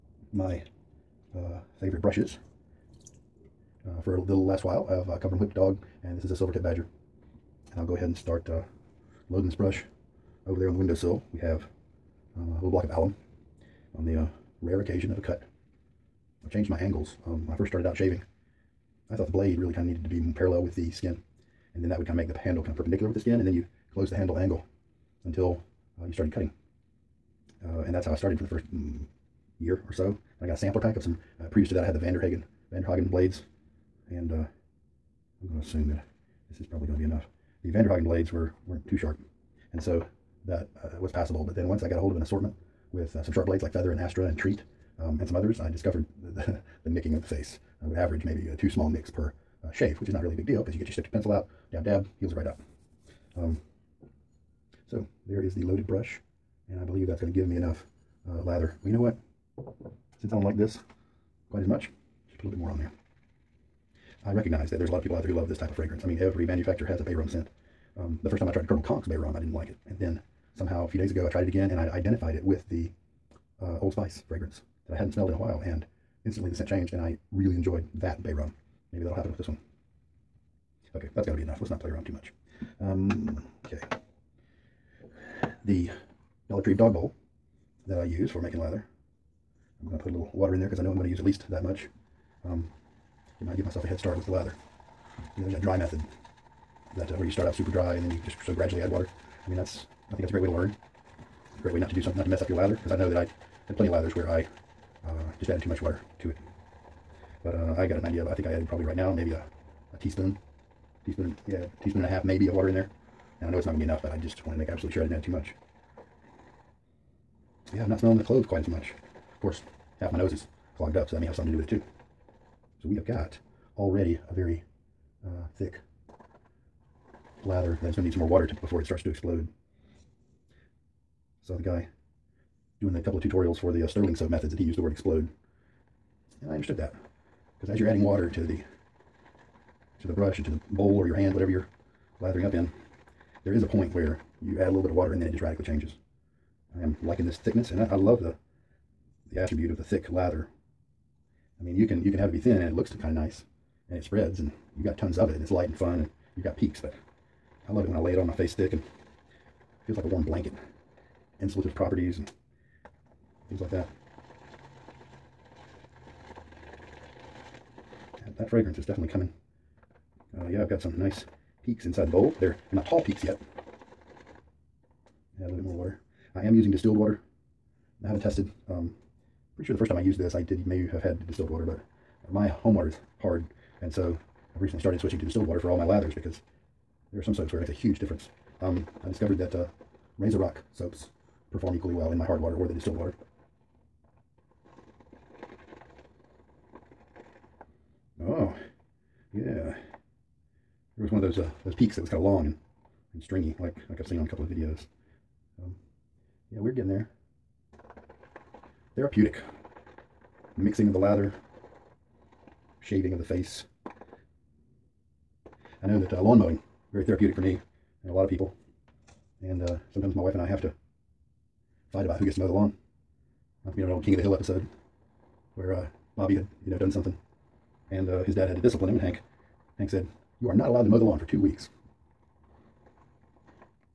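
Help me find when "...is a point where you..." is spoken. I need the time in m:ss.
2:23.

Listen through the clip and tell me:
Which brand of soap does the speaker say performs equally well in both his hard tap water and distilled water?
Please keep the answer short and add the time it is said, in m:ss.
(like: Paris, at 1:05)
Razor Rock, at 3:10.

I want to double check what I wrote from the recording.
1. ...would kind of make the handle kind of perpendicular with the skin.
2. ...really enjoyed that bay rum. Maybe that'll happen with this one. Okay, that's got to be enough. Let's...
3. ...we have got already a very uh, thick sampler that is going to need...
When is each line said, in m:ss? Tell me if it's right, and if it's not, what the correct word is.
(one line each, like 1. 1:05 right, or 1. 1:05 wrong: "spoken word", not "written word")
1. 0:21 right
2. 1:17 right
3. 2:02 wrong: "lather", not "sampler".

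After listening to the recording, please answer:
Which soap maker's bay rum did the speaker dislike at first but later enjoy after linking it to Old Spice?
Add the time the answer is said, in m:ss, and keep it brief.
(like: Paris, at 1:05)
Colonel Conk's, at 1:08.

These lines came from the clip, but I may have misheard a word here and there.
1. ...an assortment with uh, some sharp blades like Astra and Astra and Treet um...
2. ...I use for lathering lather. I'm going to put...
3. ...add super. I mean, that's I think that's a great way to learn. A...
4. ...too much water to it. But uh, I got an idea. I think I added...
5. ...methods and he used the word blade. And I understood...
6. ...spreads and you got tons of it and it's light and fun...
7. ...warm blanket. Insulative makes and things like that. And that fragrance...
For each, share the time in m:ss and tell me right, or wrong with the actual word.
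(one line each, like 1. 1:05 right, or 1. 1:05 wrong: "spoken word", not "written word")
1. 0:42 wrong: "Feather", not "Astra"
2. 1:28 wrong: "making", not "lathering"
3. 1:38 wrong: "water", not "super"
4. 1:45 right
5. 2:14 wrong: "explode", not "blade"
6. 2:34 right
7. 2:40 wrong: "properties", not "makes".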